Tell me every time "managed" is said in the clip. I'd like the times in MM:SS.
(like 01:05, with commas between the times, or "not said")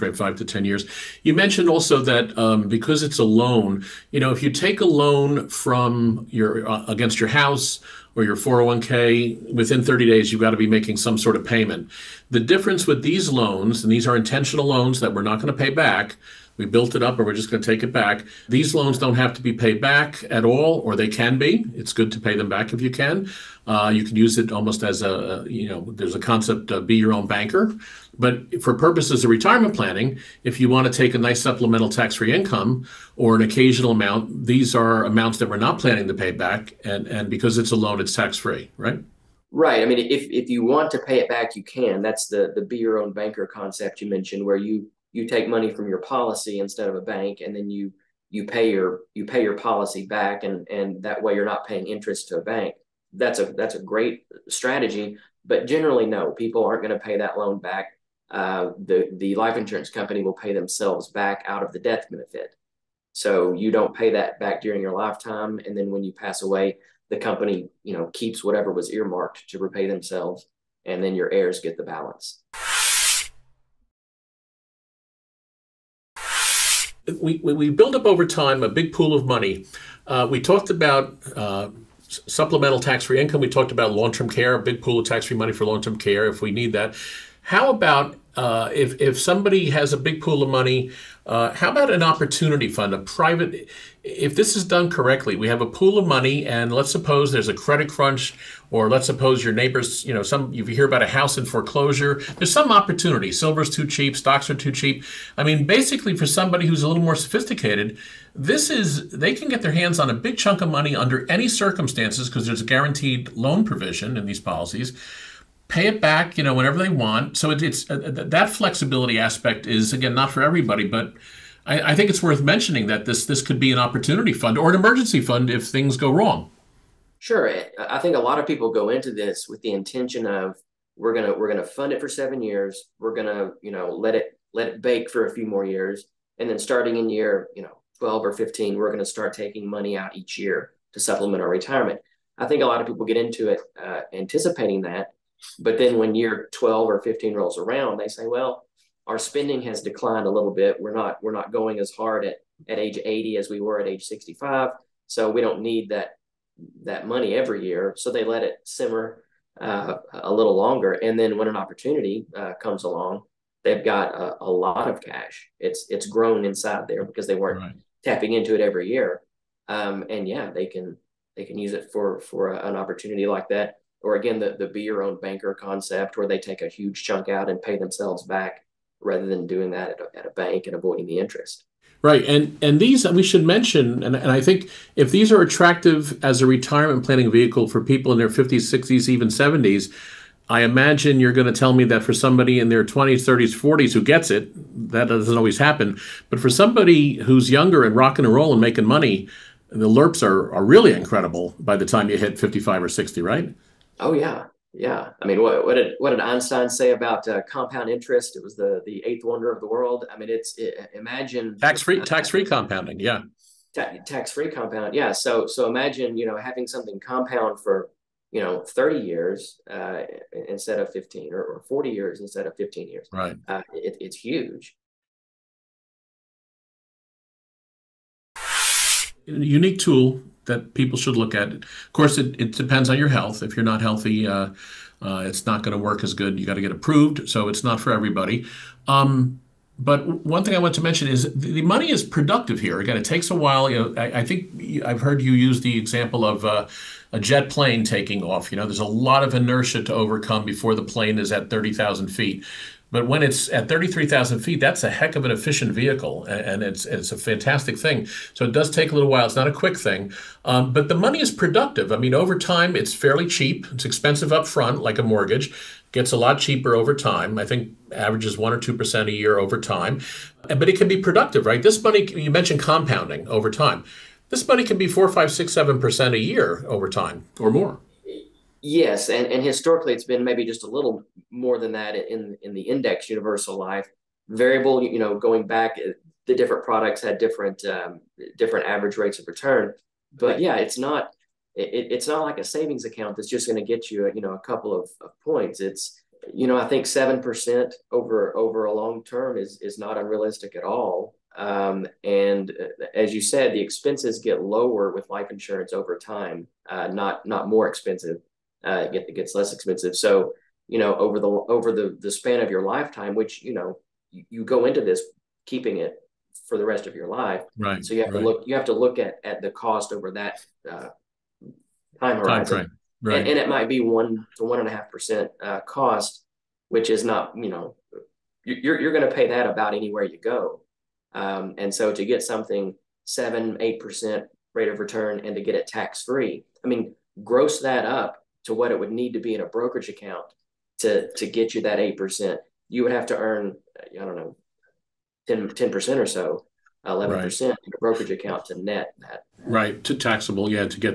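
not said.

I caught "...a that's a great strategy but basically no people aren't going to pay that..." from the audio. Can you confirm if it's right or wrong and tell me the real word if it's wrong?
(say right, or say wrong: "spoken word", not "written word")
wrong: "generally", not "basically".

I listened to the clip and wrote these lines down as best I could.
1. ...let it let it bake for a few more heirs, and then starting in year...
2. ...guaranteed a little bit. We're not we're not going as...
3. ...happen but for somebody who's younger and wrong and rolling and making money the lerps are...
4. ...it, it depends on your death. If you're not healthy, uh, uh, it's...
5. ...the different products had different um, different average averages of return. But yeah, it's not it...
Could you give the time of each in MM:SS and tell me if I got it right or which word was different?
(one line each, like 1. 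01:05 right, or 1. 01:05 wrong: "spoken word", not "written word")
1. 02:13 wrong: "years", not "heirs"
2. 02:29 wrong: "declined", not "guaranteed"
3. 03:15 wrong: "rocking", not "wrong"
4. 03:52 wrong: "health", not "death"
5. 04:46 wrong: "rates", not "averages".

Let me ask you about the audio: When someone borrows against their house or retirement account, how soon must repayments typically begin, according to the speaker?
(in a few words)
30 days.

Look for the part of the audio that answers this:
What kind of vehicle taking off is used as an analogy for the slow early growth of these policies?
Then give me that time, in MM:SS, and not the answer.
04:07.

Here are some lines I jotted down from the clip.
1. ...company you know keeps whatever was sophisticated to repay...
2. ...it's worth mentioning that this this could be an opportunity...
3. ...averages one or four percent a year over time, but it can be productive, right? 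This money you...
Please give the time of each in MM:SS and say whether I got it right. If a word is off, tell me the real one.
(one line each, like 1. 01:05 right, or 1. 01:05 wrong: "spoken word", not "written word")
1. 01:07 wrong: "earmarked", not "sophisticated"
2. 02:02 right
3. 04:27 wrong: "two", not "four".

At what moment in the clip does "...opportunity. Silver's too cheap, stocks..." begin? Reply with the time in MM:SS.
01:42.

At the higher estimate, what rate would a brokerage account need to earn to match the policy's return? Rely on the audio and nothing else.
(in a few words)
11%.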